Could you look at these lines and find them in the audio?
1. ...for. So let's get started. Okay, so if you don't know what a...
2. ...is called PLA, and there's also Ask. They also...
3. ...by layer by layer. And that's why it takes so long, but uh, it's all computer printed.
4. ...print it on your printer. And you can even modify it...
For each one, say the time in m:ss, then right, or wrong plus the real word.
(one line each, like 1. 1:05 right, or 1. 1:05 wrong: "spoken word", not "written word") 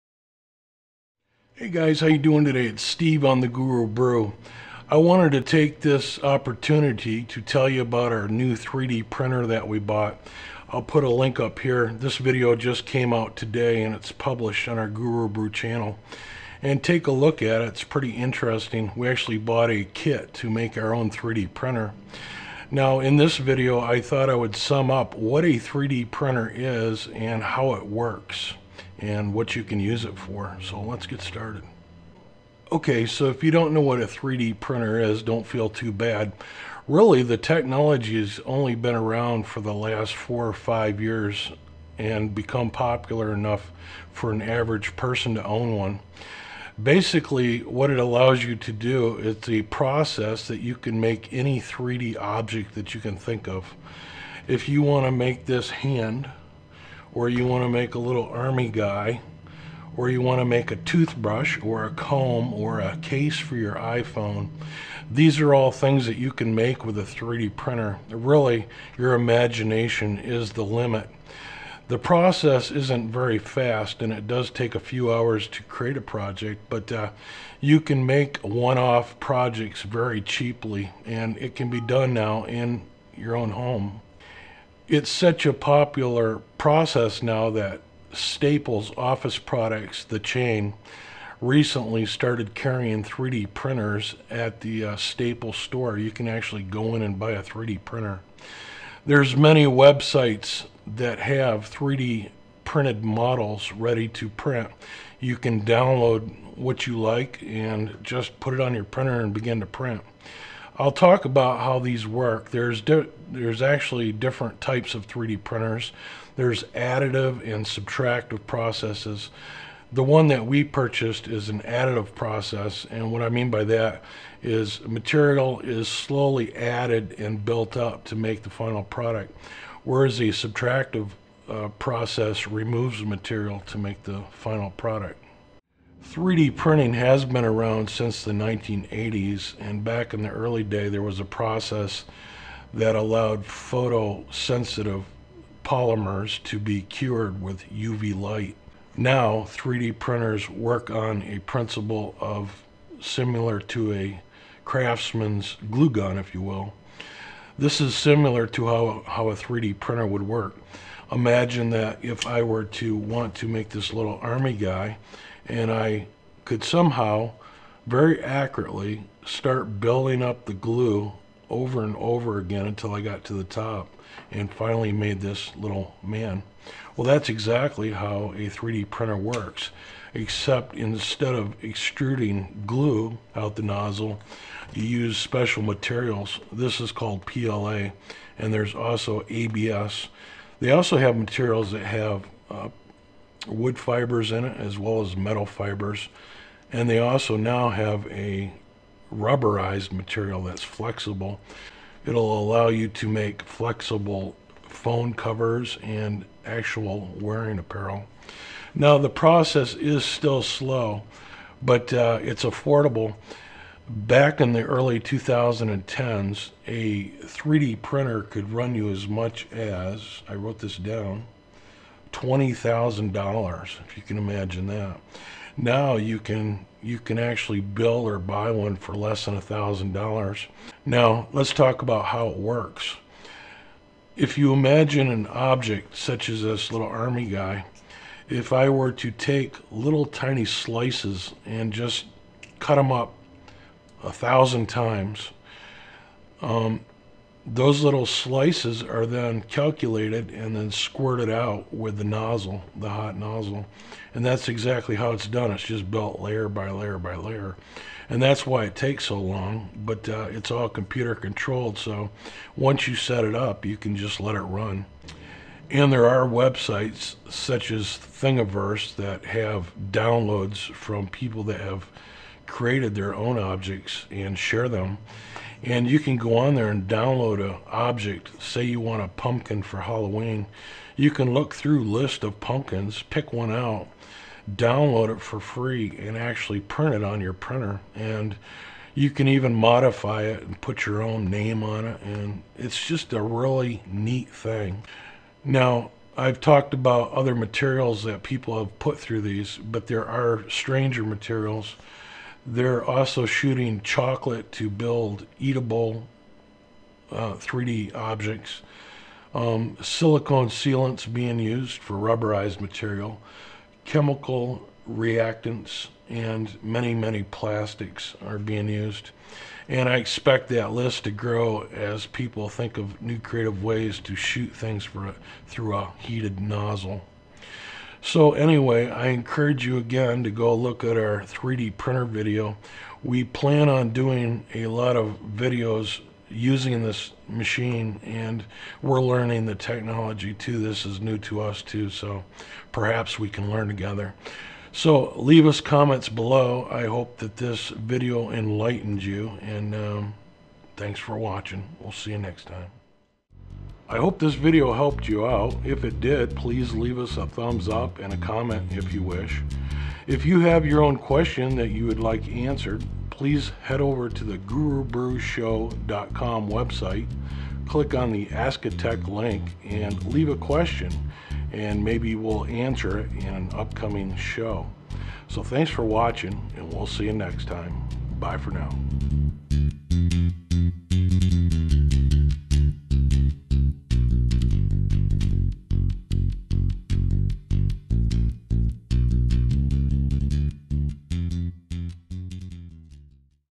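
1. 0:30 right
2. 3:06 wrong: "ABS", not "Ask"
3. 4:16 wrong: "controlled", not "printed"
4. 4:46 right.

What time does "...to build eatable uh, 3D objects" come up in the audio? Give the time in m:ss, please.
5:04.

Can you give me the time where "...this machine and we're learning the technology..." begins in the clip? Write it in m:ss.
5:36.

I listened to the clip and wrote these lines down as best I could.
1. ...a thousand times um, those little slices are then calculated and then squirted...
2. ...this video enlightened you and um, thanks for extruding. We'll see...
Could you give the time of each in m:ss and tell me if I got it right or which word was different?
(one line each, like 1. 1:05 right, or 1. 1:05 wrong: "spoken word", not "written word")
1. 4:04 right
2. 5:47 wrong: "watching", not "extruding".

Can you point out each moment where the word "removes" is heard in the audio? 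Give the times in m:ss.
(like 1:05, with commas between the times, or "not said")
2:12.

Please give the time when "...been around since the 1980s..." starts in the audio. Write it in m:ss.
2:17.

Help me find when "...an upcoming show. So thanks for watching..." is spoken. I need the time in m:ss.
6:13.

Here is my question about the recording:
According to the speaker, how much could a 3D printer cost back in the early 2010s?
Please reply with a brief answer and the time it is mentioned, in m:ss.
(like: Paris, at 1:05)
$20,000, at 3:42.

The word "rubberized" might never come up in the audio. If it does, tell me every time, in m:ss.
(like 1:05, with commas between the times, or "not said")
3:19, 5:11.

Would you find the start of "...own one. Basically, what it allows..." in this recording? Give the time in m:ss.
0:45.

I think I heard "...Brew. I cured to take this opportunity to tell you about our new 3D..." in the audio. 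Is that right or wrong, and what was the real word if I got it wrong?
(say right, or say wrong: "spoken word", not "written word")
wrong: "wanted", not "cured".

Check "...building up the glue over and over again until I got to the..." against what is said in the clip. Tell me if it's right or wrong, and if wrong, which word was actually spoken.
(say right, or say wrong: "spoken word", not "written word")
right.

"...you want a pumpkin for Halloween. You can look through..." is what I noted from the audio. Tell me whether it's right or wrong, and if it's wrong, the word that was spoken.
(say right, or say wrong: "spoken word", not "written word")
right.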